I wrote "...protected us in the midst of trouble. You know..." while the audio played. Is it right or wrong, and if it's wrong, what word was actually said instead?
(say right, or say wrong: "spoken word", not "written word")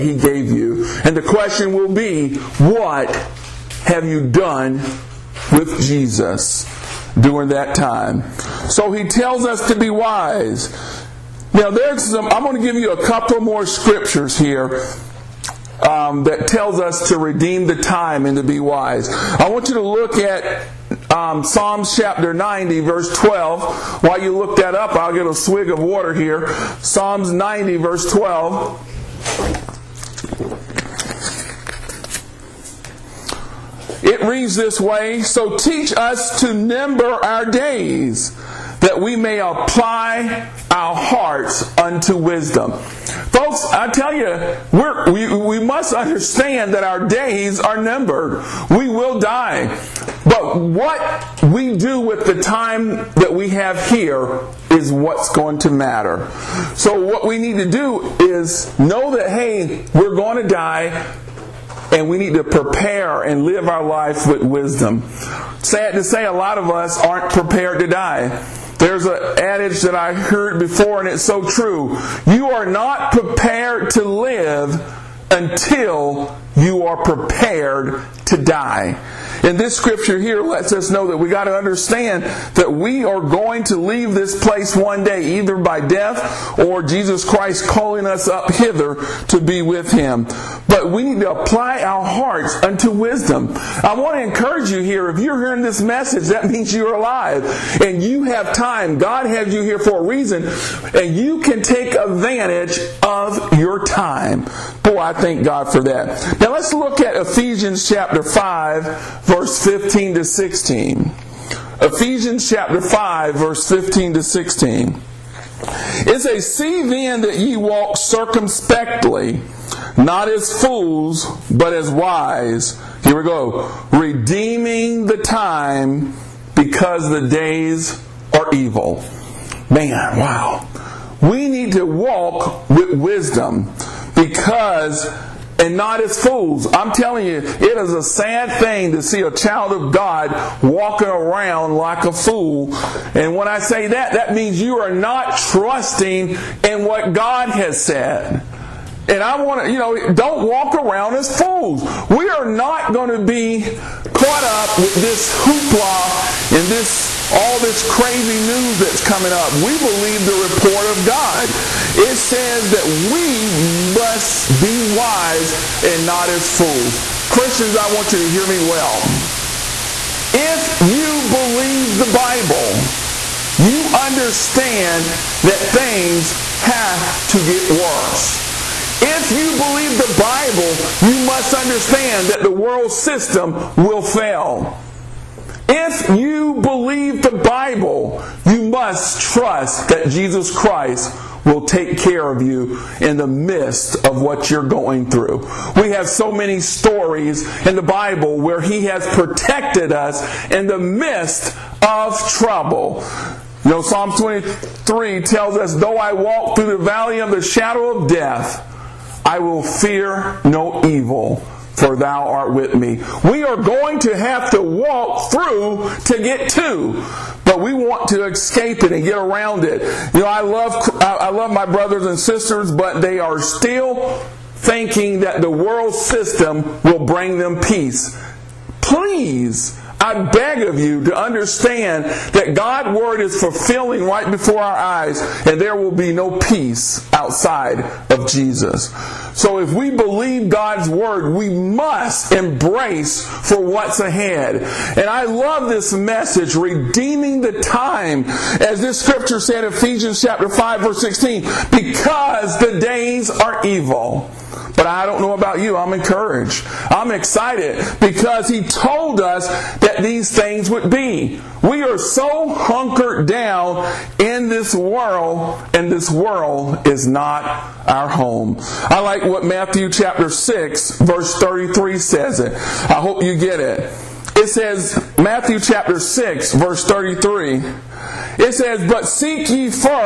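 right.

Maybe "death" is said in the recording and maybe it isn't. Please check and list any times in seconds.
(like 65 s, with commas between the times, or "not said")
85 s, 208 s.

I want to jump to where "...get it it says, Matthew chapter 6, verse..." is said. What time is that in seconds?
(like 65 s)
273 s.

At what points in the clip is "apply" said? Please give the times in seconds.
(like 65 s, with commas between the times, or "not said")
39 s, 91 s.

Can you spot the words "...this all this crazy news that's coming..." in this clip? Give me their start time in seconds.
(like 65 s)
156 s.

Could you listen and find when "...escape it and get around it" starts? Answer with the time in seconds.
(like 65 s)
218 s.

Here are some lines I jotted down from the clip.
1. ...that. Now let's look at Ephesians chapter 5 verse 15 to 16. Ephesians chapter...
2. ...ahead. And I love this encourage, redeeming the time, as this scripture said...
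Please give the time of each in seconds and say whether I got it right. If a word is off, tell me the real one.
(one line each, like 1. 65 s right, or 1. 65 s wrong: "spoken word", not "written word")
1. 105 s right
2. 243 s wrong: "message", not "encourage".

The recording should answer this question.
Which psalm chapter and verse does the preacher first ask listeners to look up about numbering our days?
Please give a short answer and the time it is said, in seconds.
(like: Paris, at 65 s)
Psalms 90:12, at 21 s.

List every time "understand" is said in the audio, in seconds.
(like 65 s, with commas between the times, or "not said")
45 s, 81 s, 173 s, 181 s, 231 s.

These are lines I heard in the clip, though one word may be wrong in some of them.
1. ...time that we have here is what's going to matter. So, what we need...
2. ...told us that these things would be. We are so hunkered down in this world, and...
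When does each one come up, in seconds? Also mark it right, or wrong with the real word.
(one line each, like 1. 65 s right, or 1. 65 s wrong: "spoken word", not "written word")
1. 52 s right
2. 258 s right.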